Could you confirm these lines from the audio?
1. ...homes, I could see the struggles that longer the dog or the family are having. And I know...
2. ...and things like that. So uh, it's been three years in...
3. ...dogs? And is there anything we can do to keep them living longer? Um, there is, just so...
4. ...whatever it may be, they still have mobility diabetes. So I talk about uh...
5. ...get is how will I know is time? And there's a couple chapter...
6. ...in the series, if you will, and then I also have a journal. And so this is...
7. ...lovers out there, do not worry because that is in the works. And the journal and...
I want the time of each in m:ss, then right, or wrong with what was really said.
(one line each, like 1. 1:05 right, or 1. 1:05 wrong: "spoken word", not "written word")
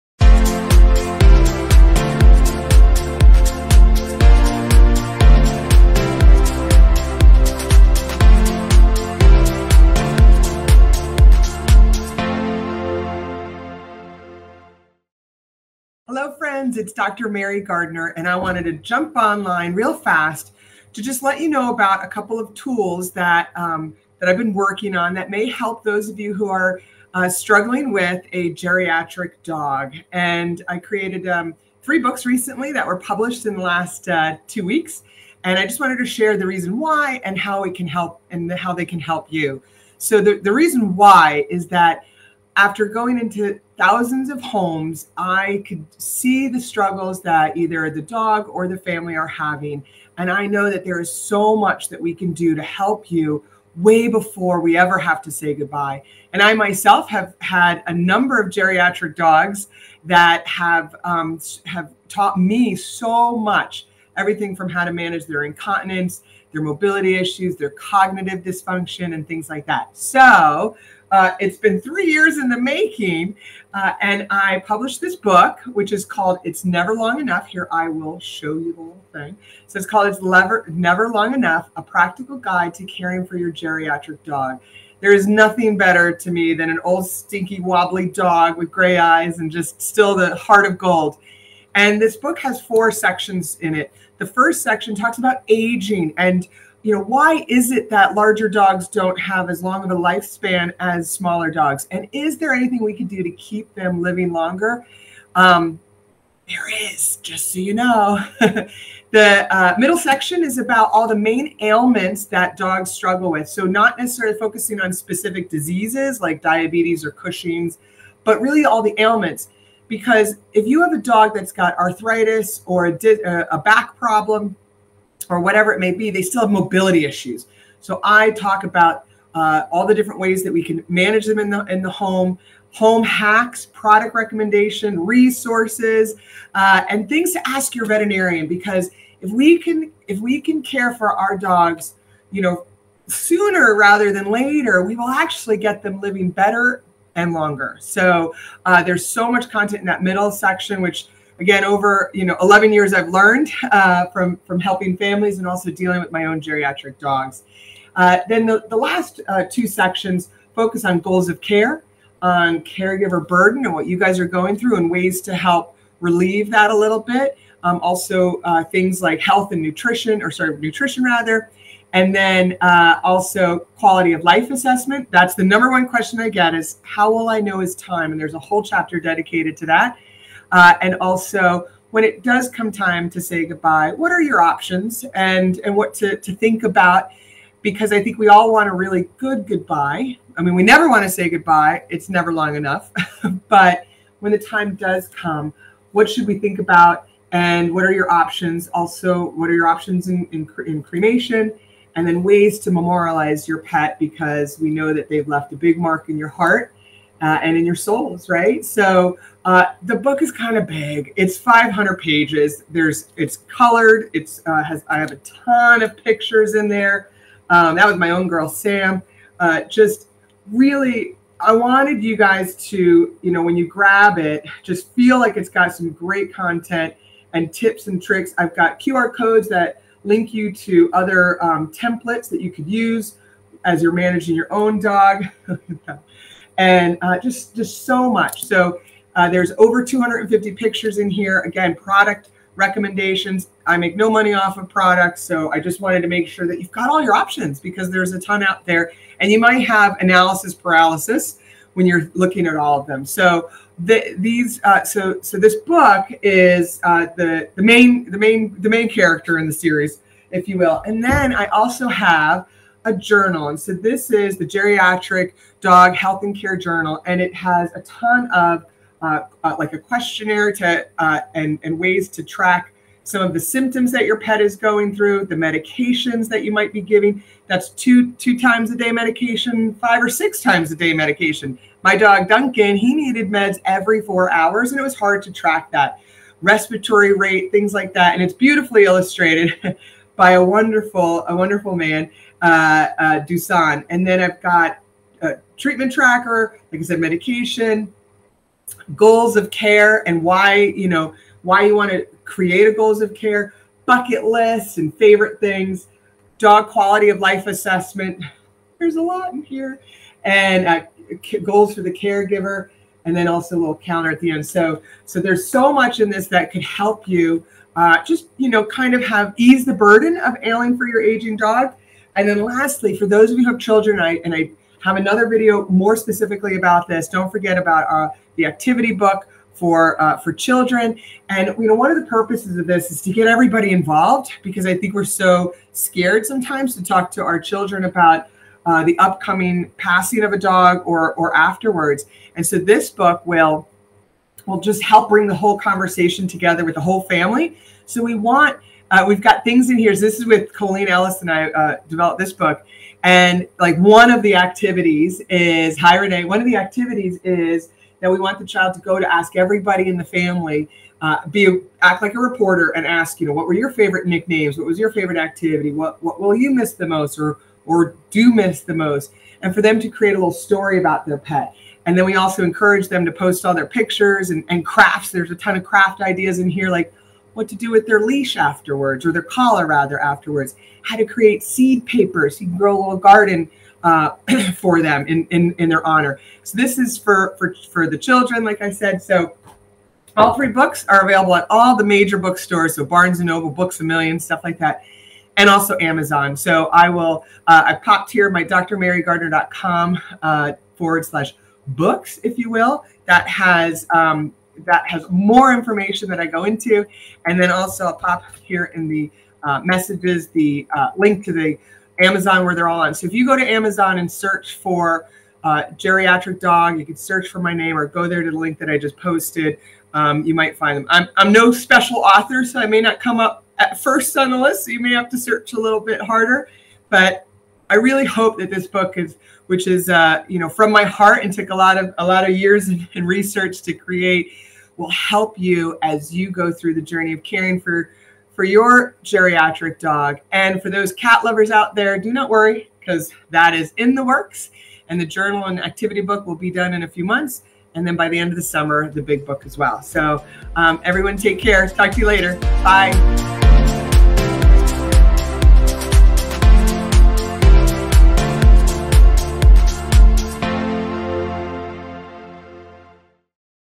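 1. 0:44 wrong: "either", not "longer"
2. 1:09 right
3. 1:41 right
4. 2:05 wrong: "issues", not "diabetes"
5. 2:56 wrong: "whole", not "couple"
6. 4:19 right
7. 7:21 right.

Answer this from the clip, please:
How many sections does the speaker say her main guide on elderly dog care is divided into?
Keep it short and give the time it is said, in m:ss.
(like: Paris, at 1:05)
4, at 1:32.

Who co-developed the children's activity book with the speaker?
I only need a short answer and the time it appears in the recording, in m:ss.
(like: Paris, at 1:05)
Coleen Ellis, at 5:50.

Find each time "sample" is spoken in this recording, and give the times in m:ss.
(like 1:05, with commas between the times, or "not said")
not said.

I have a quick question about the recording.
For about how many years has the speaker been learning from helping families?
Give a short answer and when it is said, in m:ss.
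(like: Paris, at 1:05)
11, at 2:32.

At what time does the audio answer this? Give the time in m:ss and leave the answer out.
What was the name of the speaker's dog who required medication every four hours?
4:42.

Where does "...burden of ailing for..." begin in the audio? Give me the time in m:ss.
5:19.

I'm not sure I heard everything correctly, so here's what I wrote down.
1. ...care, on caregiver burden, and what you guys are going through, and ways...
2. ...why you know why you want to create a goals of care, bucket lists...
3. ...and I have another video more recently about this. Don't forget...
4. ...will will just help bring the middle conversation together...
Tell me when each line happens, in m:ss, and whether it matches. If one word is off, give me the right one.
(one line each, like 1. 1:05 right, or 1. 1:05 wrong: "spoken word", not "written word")
1. 2:41 right
2. 5:00 right
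3. 5:24 wrong: "specifically", not "recently"
4. 5:43 wrong: "whole", not "middle".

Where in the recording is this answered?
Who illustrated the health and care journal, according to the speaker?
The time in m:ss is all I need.
4:53.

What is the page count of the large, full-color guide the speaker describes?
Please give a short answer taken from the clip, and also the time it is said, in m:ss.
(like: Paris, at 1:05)
500, at 3:31.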